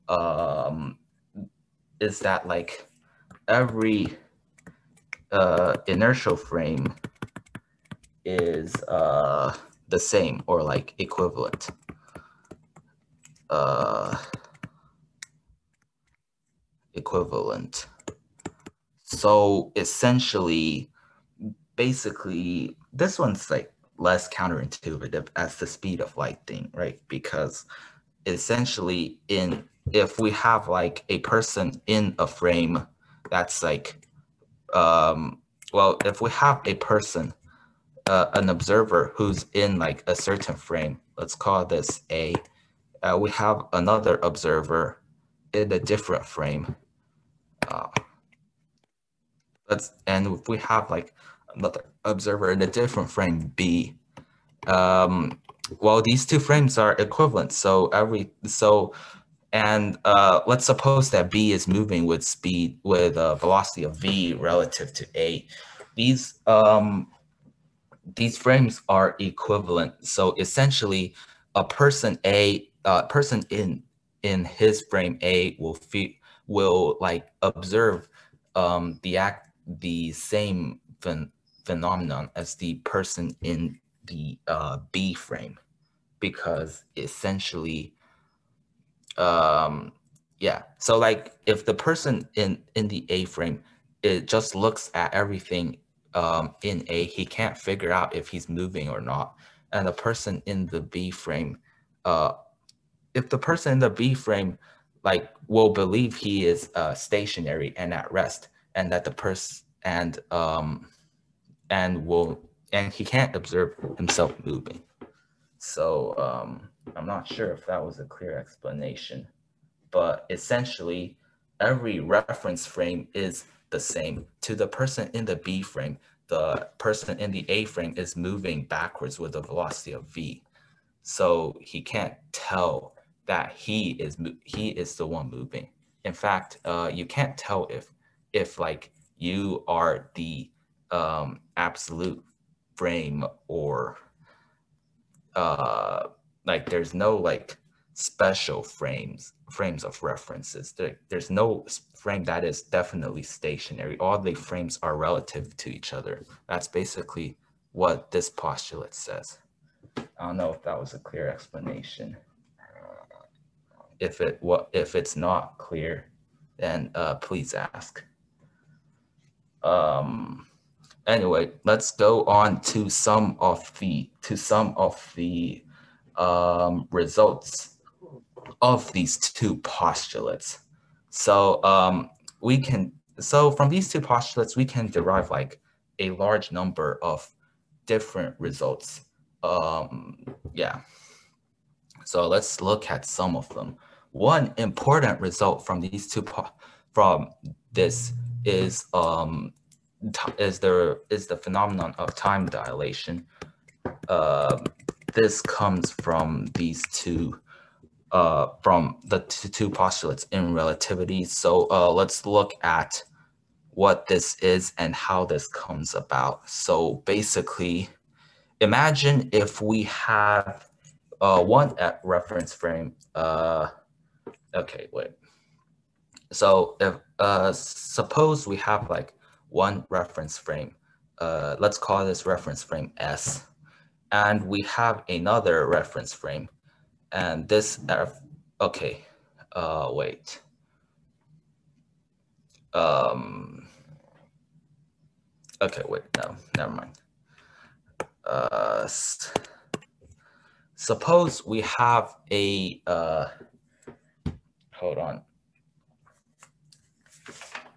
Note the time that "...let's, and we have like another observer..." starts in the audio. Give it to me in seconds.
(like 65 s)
49 s.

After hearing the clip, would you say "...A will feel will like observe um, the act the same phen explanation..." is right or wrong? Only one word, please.
wrong.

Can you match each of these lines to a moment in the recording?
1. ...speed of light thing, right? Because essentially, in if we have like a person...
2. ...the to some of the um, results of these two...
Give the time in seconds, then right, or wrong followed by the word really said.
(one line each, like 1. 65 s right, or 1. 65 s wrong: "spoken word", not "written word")
1. 25 s right
2. 173 s right.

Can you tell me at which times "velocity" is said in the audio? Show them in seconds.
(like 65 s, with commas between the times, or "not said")
63 s, 129 s.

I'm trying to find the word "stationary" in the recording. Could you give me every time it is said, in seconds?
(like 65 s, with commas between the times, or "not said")
106 s, 153 s.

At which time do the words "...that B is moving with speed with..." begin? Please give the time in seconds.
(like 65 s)
61 s.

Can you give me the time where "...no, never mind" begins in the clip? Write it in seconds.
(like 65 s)
246 s.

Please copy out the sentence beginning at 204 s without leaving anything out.
Uh, this comes from these two uh, from the two postulates in relativity.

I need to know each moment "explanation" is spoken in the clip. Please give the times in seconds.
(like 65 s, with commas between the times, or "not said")
118 s, 161 s.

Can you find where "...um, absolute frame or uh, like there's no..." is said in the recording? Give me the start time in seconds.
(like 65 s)
140 s.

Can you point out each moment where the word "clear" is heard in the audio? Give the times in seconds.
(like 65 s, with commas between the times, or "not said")
118 s, 160 s, 165 s.